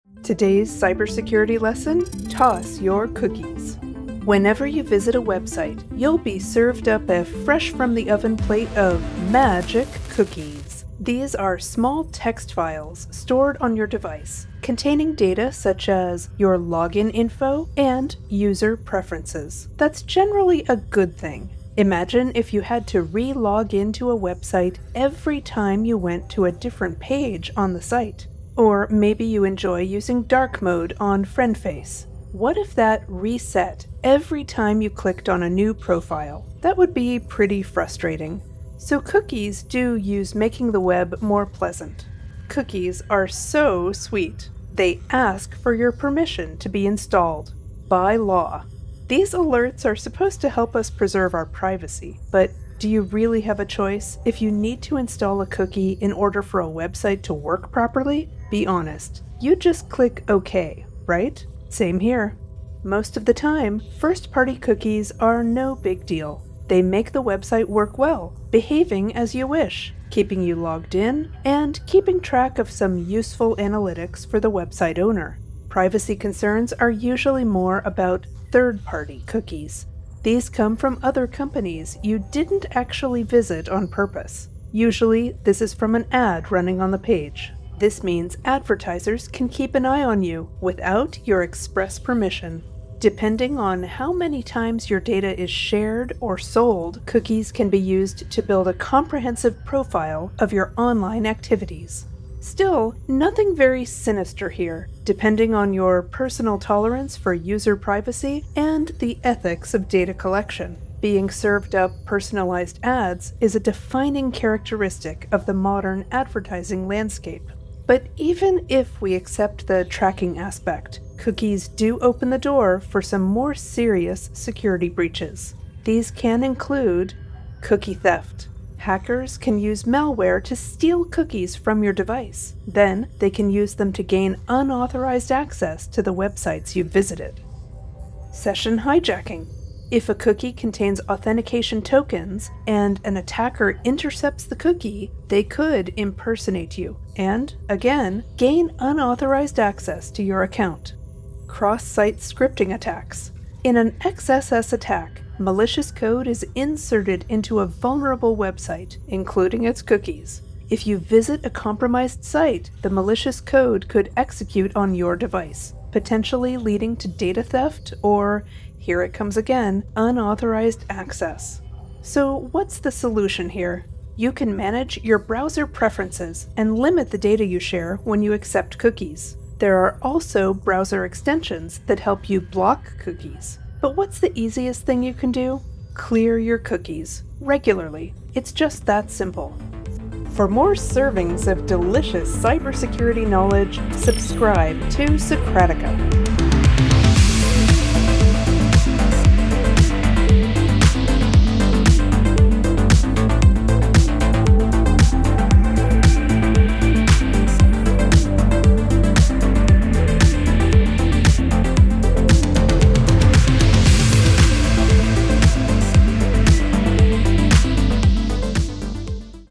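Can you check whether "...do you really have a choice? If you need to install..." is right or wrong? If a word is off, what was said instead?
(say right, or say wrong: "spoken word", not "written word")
right.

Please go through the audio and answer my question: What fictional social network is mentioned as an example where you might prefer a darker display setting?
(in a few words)
FriendFace.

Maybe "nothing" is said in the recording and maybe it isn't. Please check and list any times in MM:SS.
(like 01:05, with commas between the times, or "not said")
01:43.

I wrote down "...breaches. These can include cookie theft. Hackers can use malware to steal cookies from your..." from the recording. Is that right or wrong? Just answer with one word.
right.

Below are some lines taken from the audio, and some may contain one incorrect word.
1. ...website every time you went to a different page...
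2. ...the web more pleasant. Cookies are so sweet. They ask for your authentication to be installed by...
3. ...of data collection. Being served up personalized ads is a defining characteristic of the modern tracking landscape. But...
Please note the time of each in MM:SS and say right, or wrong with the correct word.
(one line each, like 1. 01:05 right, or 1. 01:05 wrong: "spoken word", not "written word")
1. 00:24 right
2. 00:40 wrong: "permission", not "authentication"
3. 01:49 wrong: "advertising", not "tracking".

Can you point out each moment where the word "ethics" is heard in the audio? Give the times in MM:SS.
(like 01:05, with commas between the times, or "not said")
01:49.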